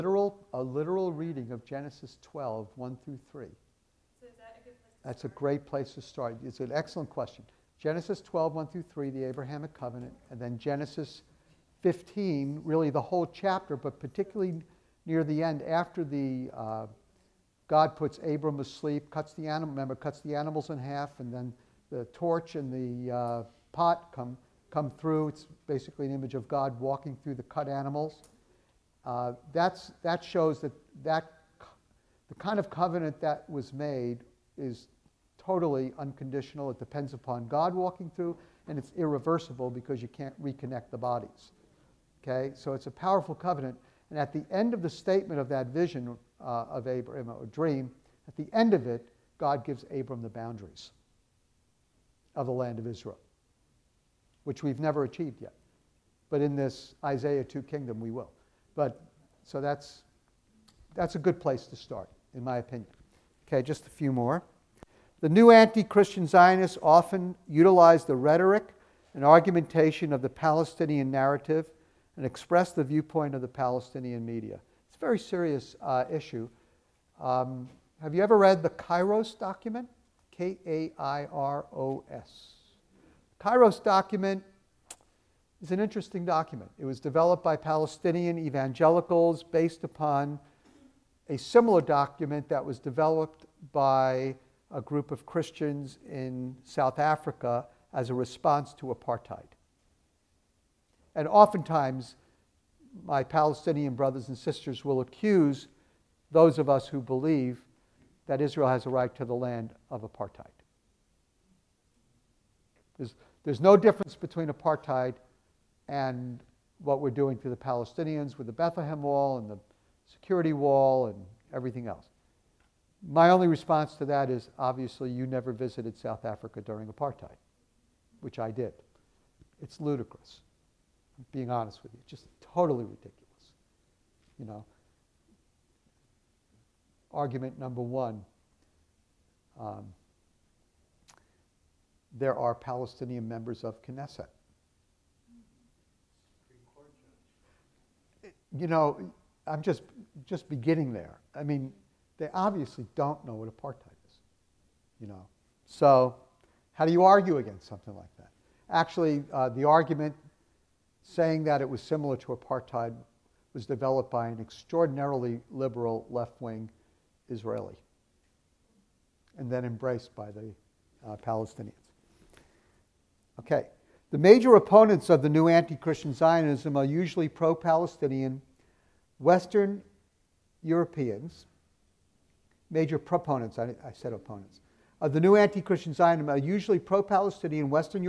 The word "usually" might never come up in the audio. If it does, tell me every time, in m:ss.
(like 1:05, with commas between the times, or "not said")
2:56, 3:06.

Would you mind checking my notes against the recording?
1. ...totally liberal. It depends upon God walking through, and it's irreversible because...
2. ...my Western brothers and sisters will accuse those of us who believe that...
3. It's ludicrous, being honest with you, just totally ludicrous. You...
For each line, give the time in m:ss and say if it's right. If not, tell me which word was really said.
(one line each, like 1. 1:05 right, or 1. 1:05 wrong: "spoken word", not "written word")
1. 0:35 wrong: "unconditional", not "liberal"
2. 1:43 wrong: "Palestinian", not "Western"
3. 2:09 wrong: "ridiculous", not "ludicrous".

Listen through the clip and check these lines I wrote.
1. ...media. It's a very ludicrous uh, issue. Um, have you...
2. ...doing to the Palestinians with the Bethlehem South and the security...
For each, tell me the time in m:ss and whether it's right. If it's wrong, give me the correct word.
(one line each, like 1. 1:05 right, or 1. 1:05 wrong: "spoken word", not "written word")
1. 1:14 wrong: "serious", not "ludicrous"
2. 1:57 wrong: "Wall", not "South".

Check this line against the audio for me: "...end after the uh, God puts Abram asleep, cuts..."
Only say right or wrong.
right.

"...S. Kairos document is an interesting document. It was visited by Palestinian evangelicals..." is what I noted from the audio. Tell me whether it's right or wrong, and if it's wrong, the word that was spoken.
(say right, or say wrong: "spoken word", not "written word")
wrong: "developed", not "visited".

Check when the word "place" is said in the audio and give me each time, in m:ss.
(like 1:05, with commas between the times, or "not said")
0:05, 1:01.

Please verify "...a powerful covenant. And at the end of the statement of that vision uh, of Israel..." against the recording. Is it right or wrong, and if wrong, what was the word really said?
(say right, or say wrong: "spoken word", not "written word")
wrong: "Abram", not "Israel".